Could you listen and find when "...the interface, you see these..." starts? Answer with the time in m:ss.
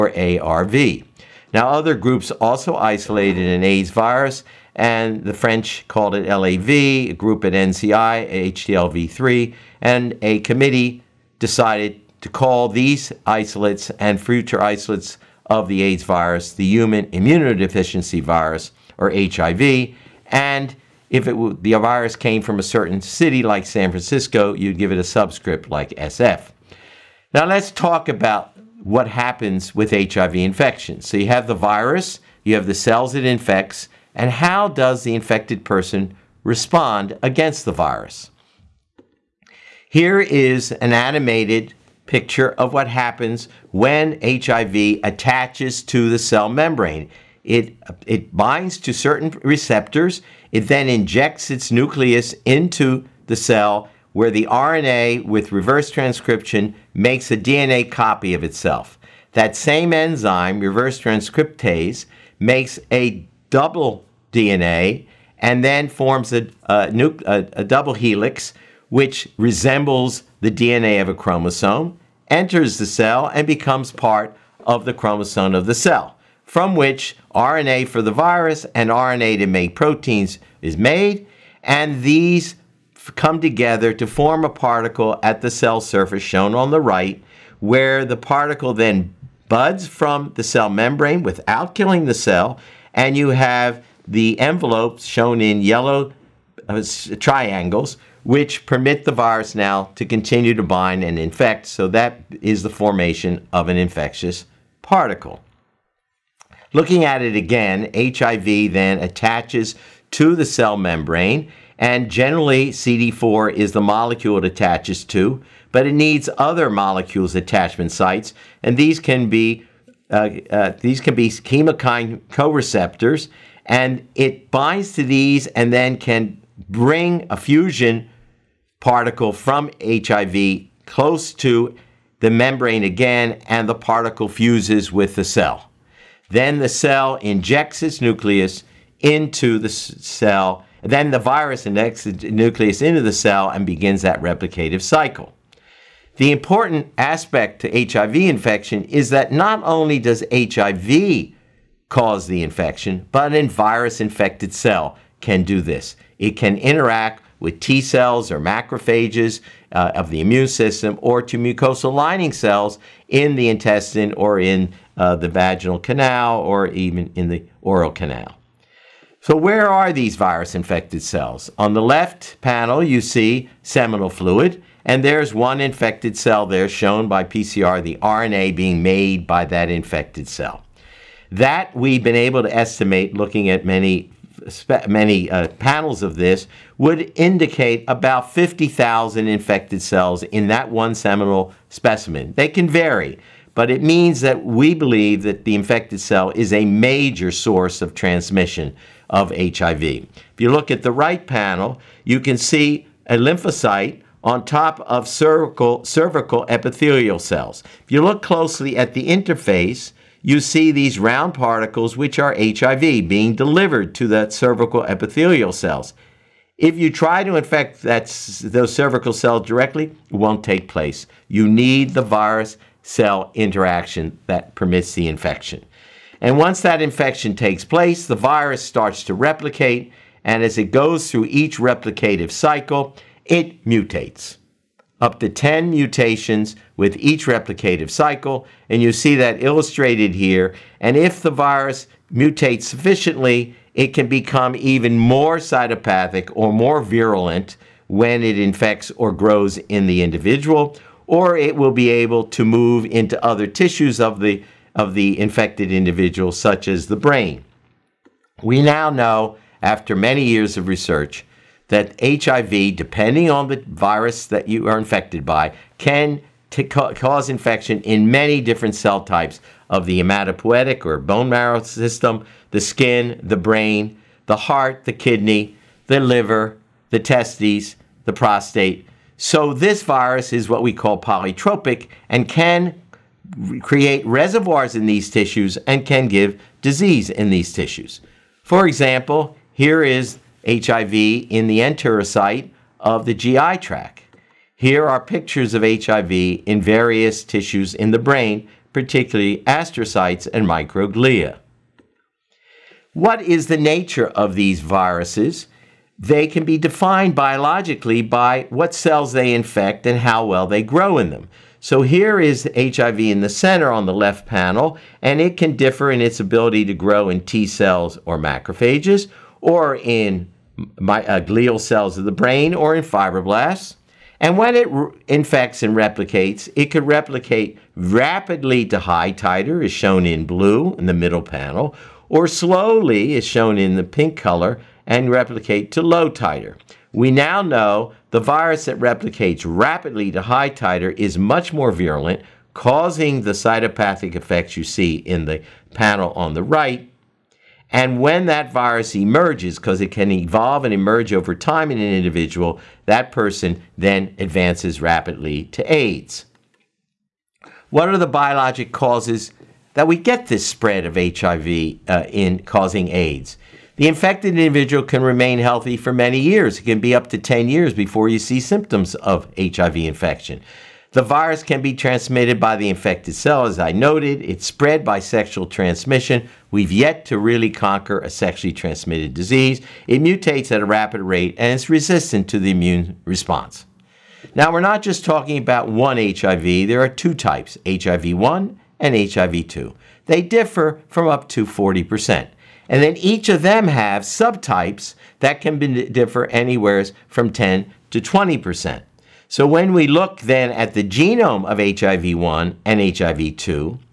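3:28.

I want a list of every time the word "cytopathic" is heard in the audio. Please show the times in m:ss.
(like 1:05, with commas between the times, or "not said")
4:05, 5:43.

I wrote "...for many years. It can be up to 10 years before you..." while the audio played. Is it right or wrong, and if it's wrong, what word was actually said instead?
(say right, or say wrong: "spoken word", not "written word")
right.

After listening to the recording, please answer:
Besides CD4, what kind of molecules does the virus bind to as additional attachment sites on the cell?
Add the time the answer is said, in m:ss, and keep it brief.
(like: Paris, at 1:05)
chemokine co-receptors, at 2:01.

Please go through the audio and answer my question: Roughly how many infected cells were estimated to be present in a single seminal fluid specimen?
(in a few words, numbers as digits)
50,000.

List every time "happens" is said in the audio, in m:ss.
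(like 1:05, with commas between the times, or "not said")
0:29, 0:42.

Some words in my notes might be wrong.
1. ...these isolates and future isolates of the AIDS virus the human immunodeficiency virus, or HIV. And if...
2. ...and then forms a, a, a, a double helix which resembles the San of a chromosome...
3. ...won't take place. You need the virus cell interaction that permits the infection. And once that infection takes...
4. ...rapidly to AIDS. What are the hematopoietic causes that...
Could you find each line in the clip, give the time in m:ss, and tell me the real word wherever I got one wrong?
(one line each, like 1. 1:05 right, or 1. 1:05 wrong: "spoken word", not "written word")
1. 0:12 right
2. 1:05 wrong: "DNA", not "San"
3. 3:40 right
4. 5:54 wrong: "biologic", not "hematopoietic".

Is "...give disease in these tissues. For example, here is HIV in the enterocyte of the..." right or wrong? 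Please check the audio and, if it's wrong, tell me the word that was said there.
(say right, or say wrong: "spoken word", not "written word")
right.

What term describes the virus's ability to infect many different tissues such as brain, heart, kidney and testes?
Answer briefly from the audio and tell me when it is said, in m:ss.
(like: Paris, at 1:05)
polytropic, at 4:40.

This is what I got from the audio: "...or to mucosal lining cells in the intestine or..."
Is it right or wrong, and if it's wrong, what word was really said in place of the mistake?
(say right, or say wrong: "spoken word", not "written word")
right.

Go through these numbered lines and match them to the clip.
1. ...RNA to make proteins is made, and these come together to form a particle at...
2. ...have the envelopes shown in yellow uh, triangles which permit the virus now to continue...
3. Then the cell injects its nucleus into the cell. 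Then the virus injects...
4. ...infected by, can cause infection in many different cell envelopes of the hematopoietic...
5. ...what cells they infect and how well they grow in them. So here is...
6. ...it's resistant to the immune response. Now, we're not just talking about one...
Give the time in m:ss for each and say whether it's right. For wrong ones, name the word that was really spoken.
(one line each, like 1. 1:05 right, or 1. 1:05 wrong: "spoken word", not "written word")
1. 1:18 right
2. 1:33 right
3. 2:16 right
4. 4:24 wrong: "types", not "envelopes"
5. 5:08 right
6. 6:21 right.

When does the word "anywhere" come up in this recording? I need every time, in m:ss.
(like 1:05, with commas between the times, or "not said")
6:36.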